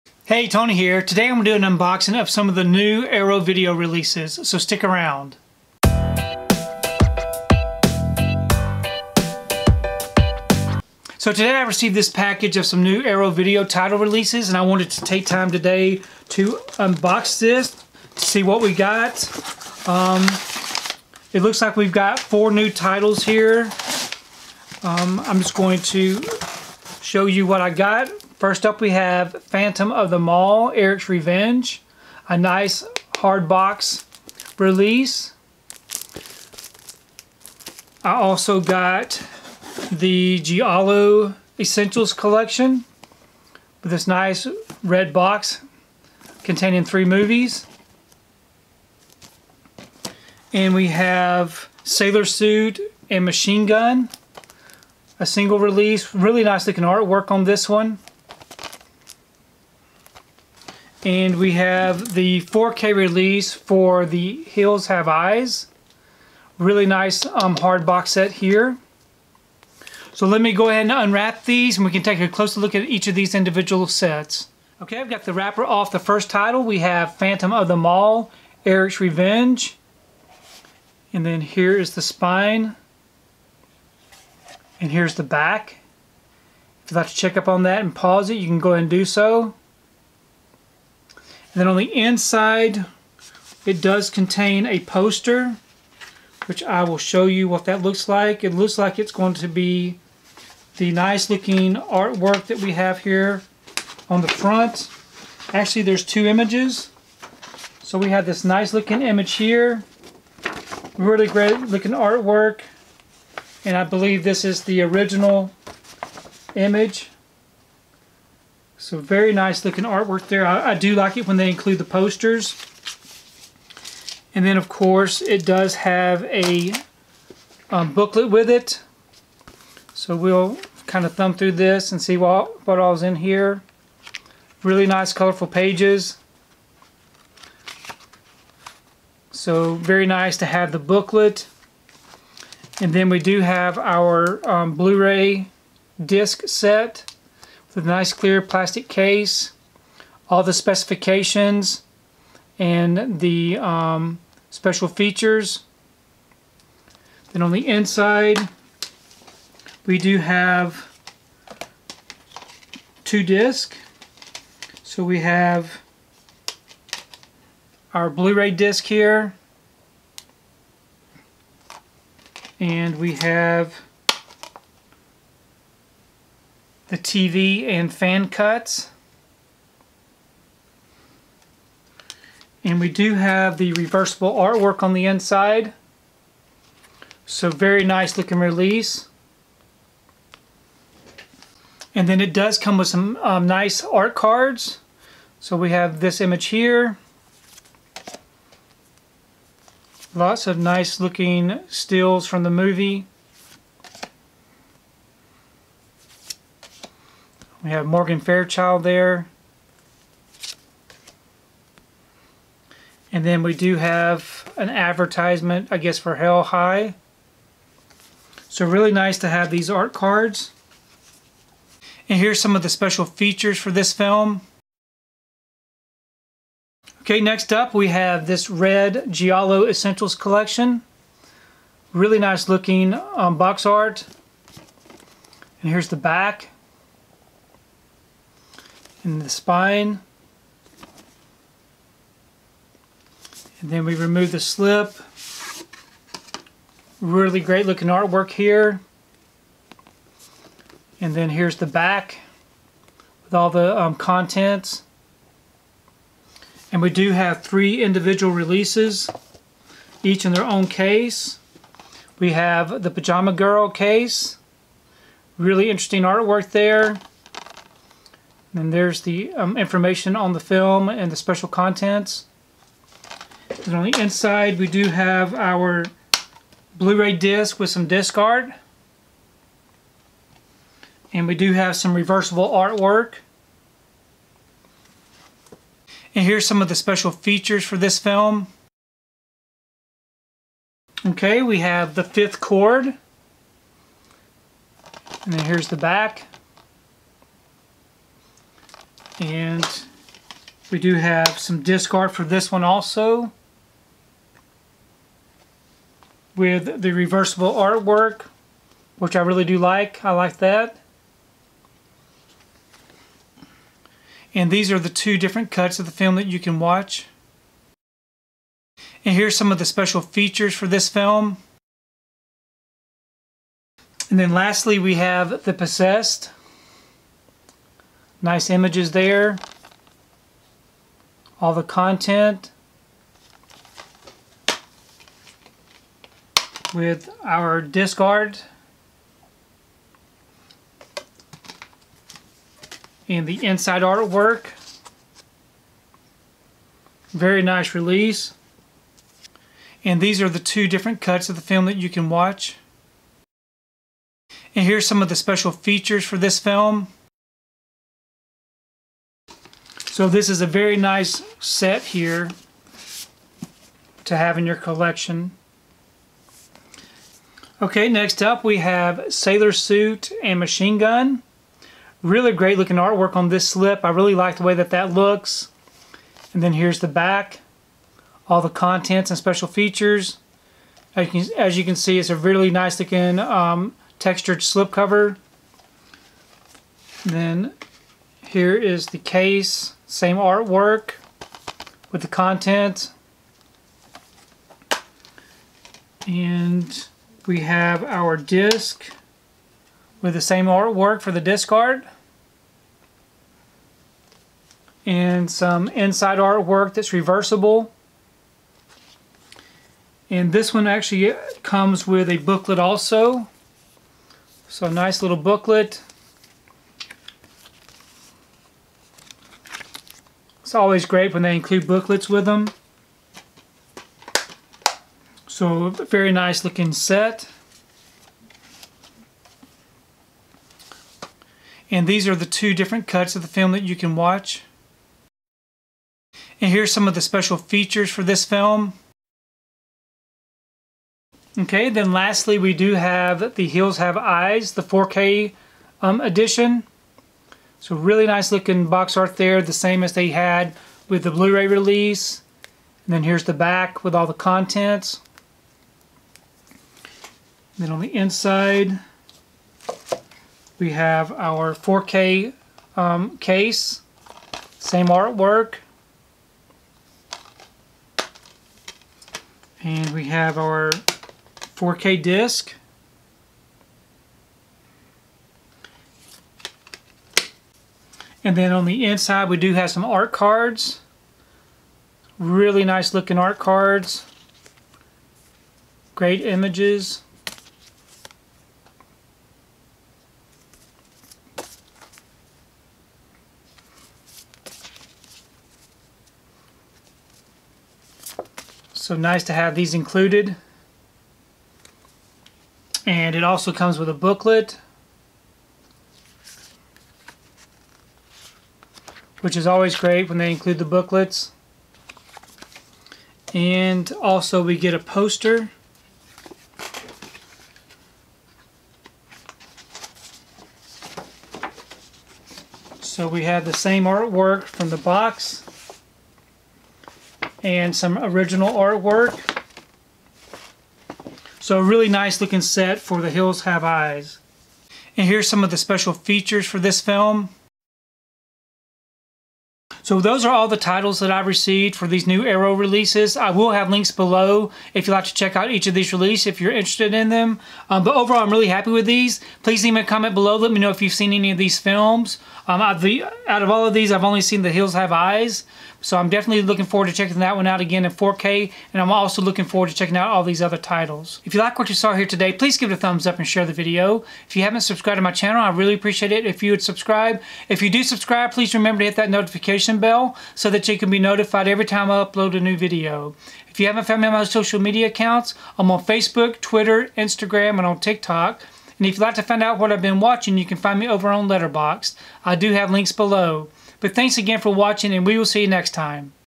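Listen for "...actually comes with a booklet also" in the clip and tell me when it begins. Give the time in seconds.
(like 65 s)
410 s.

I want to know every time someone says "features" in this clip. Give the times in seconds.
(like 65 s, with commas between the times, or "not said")
154 s, 223 s, 287 s, 320 s, 355 s, 379 s, 437 s, 535 s.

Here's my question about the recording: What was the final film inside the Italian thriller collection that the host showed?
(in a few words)
The Possessed.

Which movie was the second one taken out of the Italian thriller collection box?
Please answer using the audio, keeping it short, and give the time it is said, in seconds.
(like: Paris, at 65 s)
The Fifth Cord, at 291 s.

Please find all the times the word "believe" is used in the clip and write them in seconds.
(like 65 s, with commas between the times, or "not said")
113 s.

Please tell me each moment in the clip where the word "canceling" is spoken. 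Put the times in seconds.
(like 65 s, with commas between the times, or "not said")
not said.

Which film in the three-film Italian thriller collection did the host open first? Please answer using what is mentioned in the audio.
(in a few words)
Pajama Girl.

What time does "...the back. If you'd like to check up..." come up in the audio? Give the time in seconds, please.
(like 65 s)
85 s.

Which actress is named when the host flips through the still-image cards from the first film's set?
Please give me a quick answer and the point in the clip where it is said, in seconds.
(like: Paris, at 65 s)
Morgan Fairchild, at 207 s.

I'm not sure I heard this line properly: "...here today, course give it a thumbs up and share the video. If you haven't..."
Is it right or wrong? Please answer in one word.
wrong.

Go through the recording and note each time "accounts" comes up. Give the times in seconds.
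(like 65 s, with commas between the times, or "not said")
574 s.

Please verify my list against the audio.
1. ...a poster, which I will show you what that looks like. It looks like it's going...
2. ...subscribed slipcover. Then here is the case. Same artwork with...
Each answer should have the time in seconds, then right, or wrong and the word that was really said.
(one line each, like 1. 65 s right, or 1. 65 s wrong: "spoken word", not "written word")
1. 94 s right
2. 383 s wrong: "textured", not "subscribed".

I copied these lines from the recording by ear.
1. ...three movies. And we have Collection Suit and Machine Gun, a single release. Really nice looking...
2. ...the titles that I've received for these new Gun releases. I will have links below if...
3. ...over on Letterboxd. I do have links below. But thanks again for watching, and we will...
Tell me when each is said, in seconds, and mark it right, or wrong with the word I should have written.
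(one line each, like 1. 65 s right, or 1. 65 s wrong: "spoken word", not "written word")
1. 46 s wrong: "Sailor", not "Collection"
2. 540 s wrong: "Arrow", not "Gun"
3. 580 s right.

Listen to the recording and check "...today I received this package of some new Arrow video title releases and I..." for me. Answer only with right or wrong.
right.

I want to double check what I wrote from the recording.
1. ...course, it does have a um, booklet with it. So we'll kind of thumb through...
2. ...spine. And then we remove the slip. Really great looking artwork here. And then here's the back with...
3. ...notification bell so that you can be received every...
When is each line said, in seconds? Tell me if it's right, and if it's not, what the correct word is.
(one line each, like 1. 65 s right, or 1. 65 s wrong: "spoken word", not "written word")
1. 124 s right
2. 239 s right
3. 569 s wrong: "notified", not "received".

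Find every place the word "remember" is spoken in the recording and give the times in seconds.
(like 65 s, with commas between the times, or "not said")
568 s.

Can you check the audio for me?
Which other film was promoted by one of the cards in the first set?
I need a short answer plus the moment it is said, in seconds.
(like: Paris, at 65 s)
Hell High, at 216 s.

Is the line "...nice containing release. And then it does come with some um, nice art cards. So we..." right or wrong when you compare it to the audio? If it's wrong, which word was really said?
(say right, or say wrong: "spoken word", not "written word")
wrong: "looking", not "containing".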